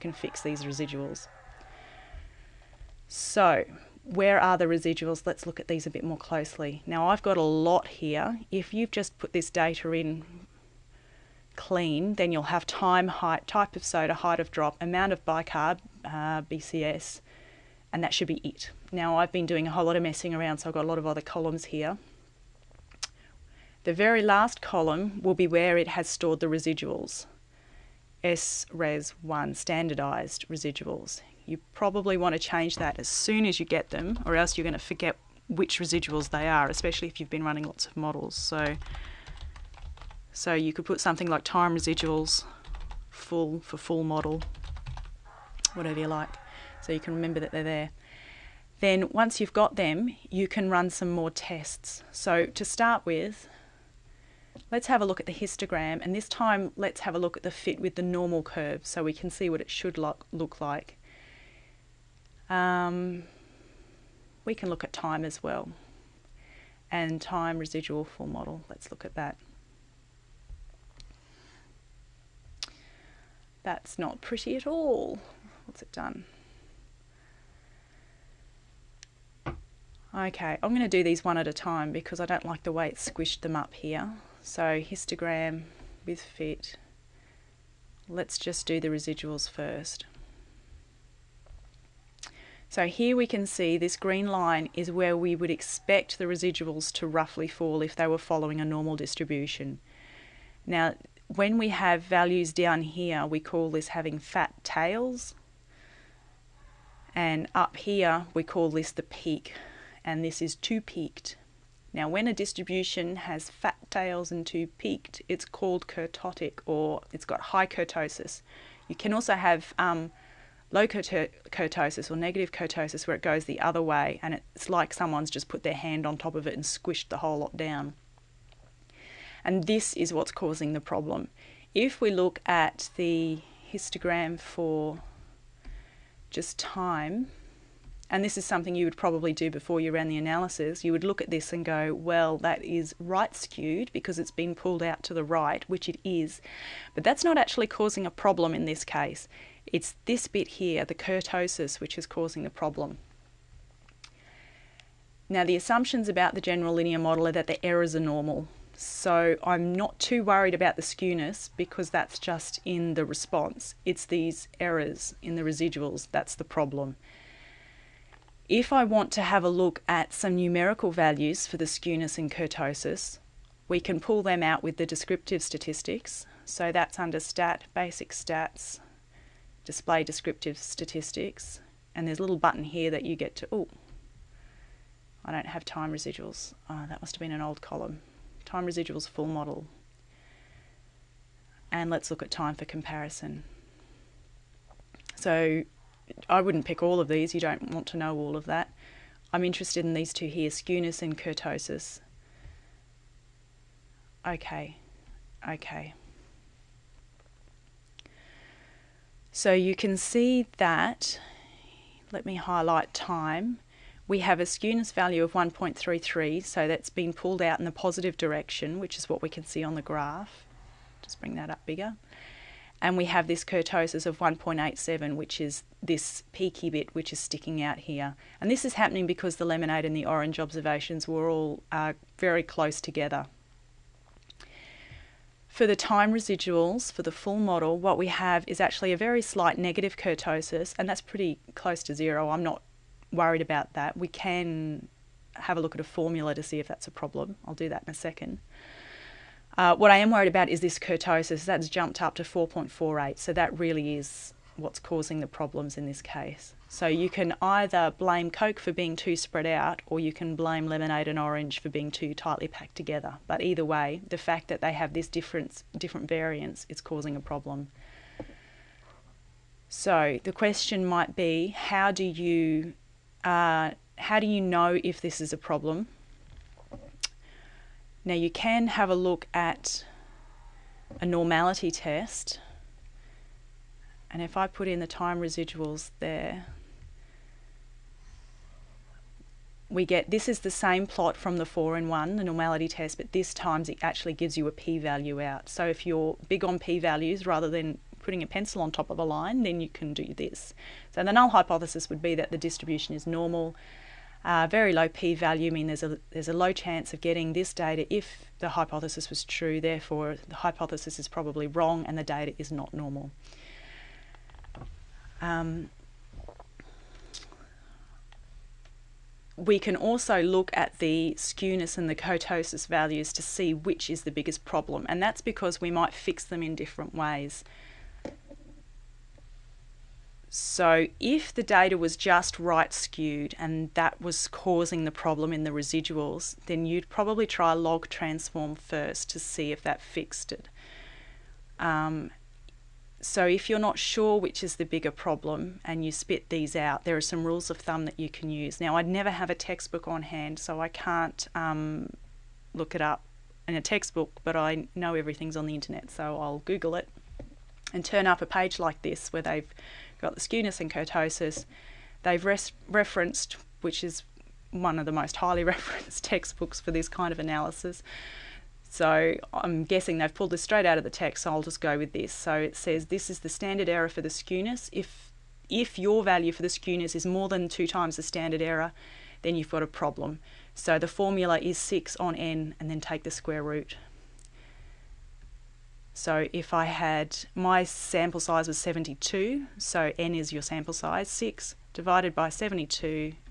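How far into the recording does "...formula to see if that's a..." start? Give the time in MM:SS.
04:05.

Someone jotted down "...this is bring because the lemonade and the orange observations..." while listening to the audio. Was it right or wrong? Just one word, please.
wrong.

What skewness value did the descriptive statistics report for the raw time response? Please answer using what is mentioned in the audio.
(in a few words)
1.33.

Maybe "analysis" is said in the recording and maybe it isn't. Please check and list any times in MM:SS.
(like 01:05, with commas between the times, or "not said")
02:20, 06:07.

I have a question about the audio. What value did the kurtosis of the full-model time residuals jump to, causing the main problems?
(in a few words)
4.48.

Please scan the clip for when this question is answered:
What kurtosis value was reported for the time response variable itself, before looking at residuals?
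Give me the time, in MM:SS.
03:44.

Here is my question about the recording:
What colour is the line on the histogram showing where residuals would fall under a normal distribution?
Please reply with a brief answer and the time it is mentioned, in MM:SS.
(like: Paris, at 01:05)
green, at 01:33.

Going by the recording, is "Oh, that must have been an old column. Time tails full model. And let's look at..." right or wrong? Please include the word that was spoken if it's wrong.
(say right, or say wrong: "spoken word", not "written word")
wrong: "residuals", not "tails".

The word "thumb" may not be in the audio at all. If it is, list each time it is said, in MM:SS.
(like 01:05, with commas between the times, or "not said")
05:47.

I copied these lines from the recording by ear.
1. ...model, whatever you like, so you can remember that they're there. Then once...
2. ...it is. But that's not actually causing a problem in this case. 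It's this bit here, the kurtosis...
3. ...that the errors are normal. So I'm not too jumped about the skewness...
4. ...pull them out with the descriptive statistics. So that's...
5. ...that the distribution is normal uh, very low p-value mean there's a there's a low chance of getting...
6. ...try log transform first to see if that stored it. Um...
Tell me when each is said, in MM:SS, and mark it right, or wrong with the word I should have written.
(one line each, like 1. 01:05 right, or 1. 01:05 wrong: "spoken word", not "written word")
1. 00:44 right
2. 02:25 right
3. 02:37 wrong: "worried", not "jumped"
4. 02:54 right
5. 05:02 right
6. 05:37 wrong: "fixed", not "stored".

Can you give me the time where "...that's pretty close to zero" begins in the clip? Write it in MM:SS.
04:00.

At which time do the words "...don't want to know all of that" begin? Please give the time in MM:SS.
03:17.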